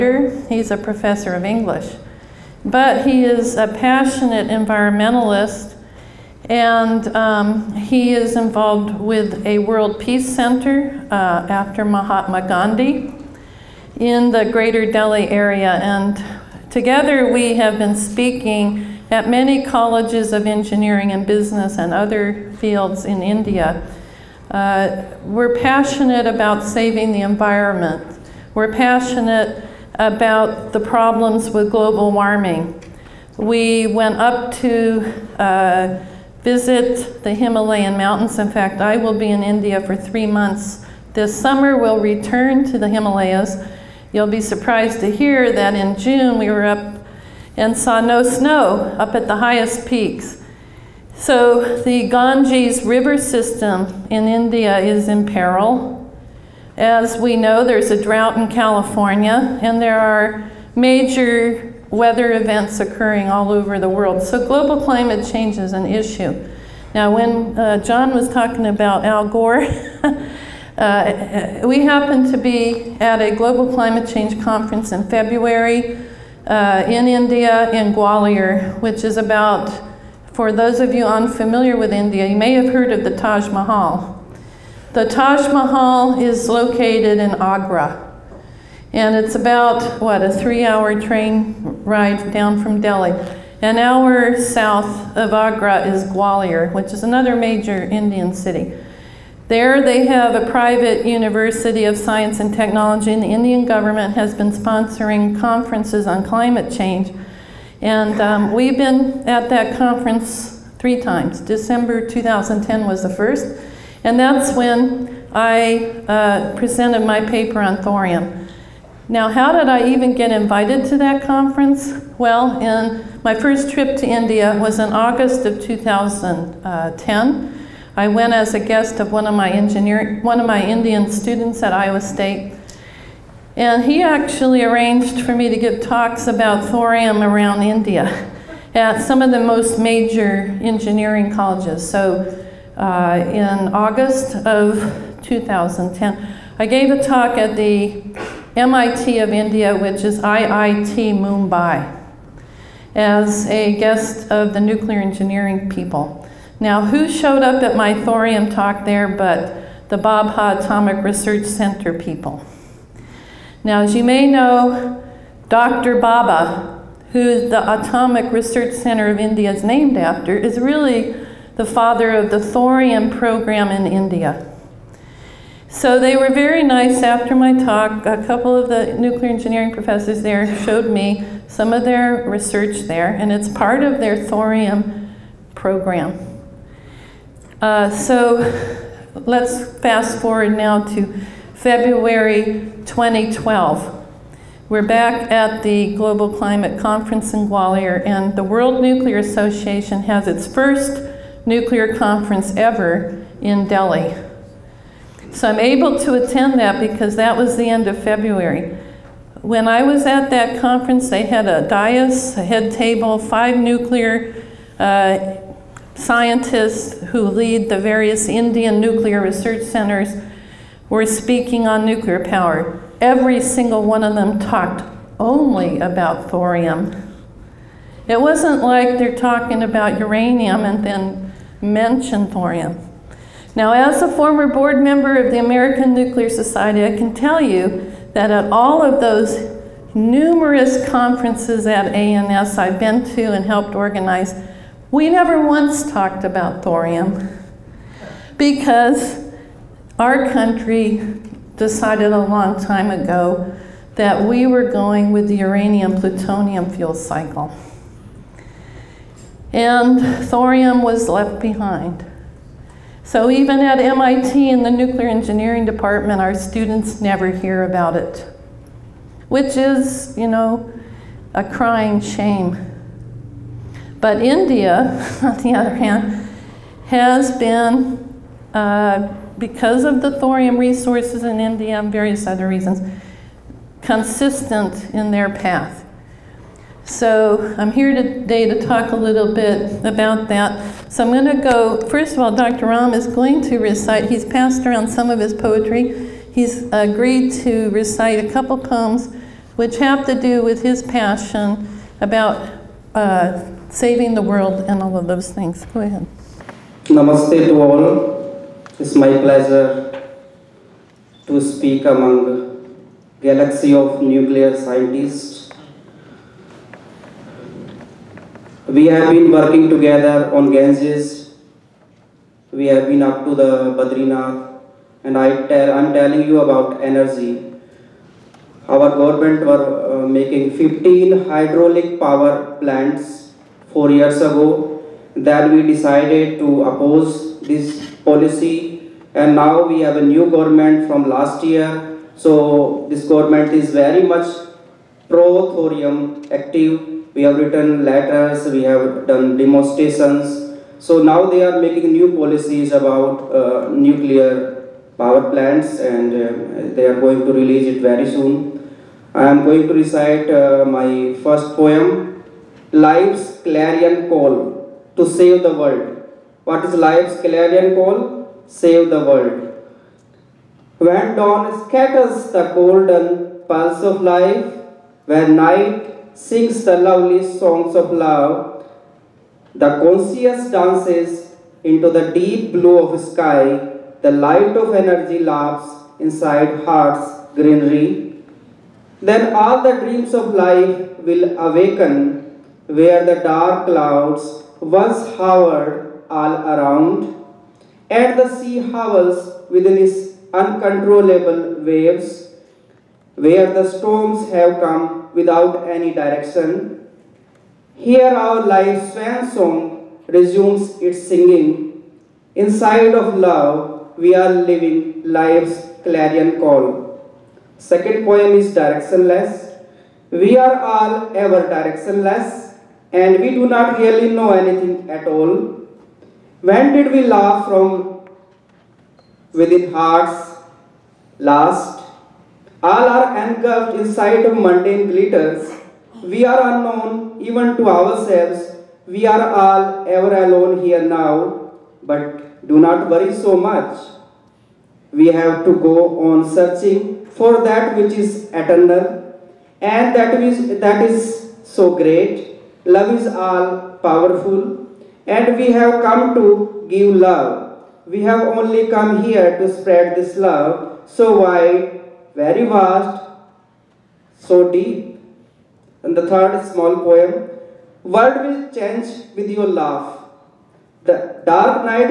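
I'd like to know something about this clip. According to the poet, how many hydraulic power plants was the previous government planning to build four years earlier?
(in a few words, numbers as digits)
15.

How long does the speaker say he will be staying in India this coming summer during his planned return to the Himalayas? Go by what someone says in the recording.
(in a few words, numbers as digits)
3 months.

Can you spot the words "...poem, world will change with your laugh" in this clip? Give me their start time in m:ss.
7:46.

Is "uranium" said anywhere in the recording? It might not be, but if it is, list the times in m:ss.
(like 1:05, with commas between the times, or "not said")
3:49, 4:15.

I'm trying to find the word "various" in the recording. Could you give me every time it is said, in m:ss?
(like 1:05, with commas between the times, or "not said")
3:37, 4:41.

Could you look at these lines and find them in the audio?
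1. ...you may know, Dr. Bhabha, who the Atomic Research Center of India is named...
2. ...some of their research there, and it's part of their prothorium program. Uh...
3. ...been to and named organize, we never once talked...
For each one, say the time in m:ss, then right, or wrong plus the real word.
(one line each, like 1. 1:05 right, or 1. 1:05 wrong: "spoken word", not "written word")
1. 2:43 right
2. 3:01 wrong: "thorium", not "prothorium"
3. 4:02 wrong: "helped", not "named".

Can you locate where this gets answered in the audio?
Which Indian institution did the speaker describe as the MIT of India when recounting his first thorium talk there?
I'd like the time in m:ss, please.
2:30.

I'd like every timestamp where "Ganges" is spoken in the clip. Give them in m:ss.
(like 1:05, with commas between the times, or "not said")
0:52, 5:20.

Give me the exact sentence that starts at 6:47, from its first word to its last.
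Here our life's swan song resumes its singing.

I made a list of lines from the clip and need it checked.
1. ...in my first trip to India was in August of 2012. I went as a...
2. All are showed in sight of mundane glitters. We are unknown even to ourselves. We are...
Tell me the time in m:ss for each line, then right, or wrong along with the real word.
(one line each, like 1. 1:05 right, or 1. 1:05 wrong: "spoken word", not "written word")
1. 2:02 wrong: "2010", not "2012"
2. 7:12 wrong: "engulfed", not "showed".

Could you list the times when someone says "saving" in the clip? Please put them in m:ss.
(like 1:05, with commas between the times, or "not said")
0:26, 5:03.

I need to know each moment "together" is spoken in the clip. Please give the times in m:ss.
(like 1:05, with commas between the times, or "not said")
0:16, 5:19.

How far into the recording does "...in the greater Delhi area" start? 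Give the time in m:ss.
0:13.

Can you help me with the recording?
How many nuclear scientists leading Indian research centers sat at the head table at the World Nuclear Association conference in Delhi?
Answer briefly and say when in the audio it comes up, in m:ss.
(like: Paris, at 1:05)
5, at 3:33.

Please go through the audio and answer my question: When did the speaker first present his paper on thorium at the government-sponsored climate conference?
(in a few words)
December 2010.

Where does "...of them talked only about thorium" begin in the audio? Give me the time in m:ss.
3:44.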